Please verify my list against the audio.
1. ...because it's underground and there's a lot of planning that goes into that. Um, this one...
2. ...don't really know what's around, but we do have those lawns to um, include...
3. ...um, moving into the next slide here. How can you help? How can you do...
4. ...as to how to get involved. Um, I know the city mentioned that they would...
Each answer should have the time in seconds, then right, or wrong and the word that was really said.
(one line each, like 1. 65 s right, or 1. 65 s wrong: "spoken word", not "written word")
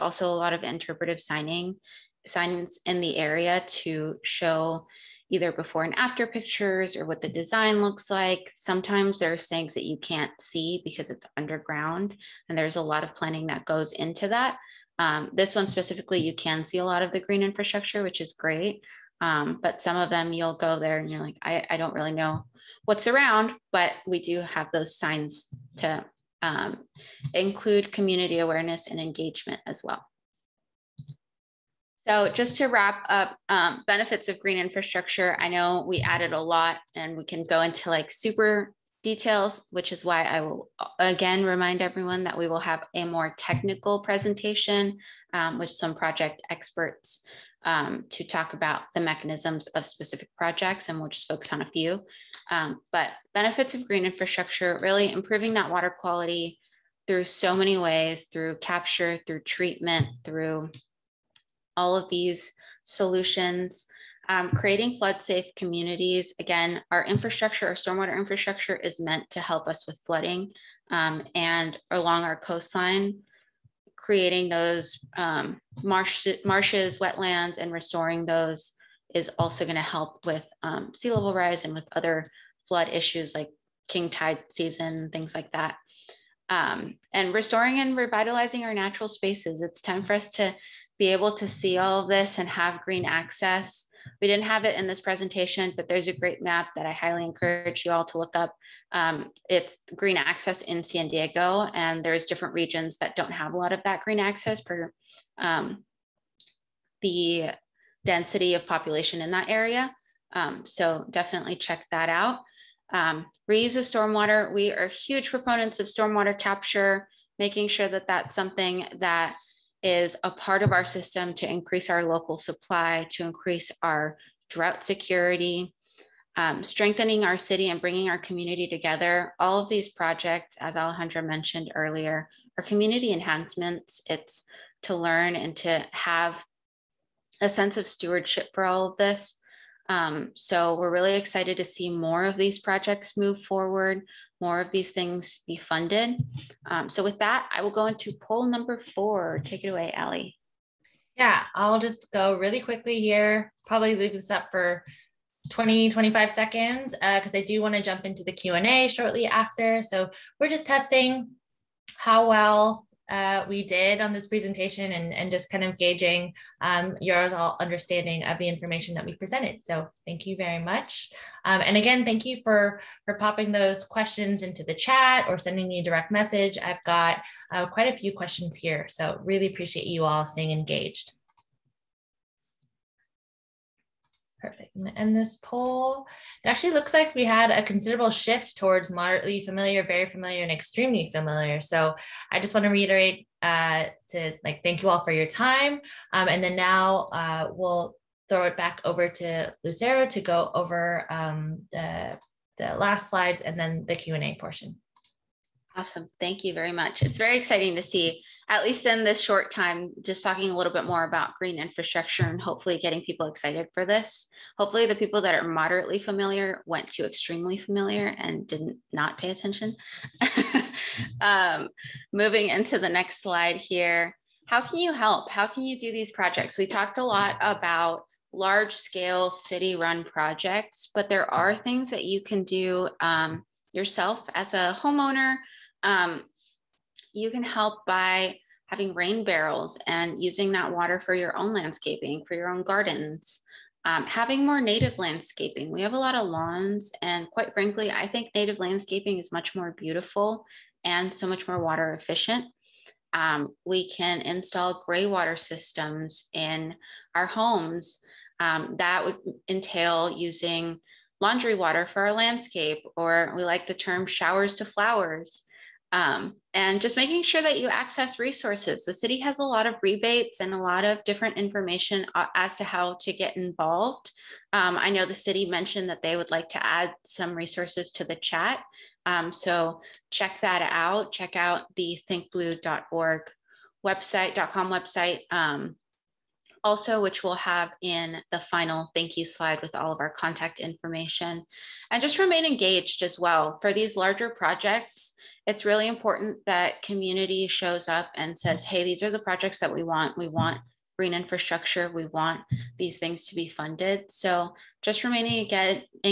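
1. 10 s right
2. 21 s wrong: "signs", not "lawns"
3. 221 s right
4. 272 s right.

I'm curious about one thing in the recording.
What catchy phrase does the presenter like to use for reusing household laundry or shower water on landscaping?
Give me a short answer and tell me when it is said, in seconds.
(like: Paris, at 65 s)
Showers to flowers, at 264 s.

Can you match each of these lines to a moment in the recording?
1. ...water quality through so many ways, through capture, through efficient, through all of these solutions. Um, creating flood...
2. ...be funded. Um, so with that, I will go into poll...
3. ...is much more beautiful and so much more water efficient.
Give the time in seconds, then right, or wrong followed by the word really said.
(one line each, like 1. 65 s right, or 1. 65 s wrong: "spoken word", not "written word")
1. 55 s wrong: "treatment", not "efficient"
2. 145 s right
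3. 249 s right.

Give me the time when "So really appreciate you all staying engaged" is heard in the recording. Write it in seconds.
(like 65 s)
178 s.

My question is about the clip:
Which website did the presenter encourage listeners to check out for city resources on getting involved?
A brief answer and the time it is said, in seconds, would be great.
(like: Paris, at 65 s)
thinkblue.org, at 282 s.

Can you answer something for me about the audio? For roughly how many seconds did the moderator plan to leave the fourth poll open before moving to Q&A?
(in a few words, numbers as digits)
20 to 25 seconds.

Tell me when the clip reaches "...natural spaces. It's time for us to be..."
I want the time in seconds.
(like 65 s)
88 s.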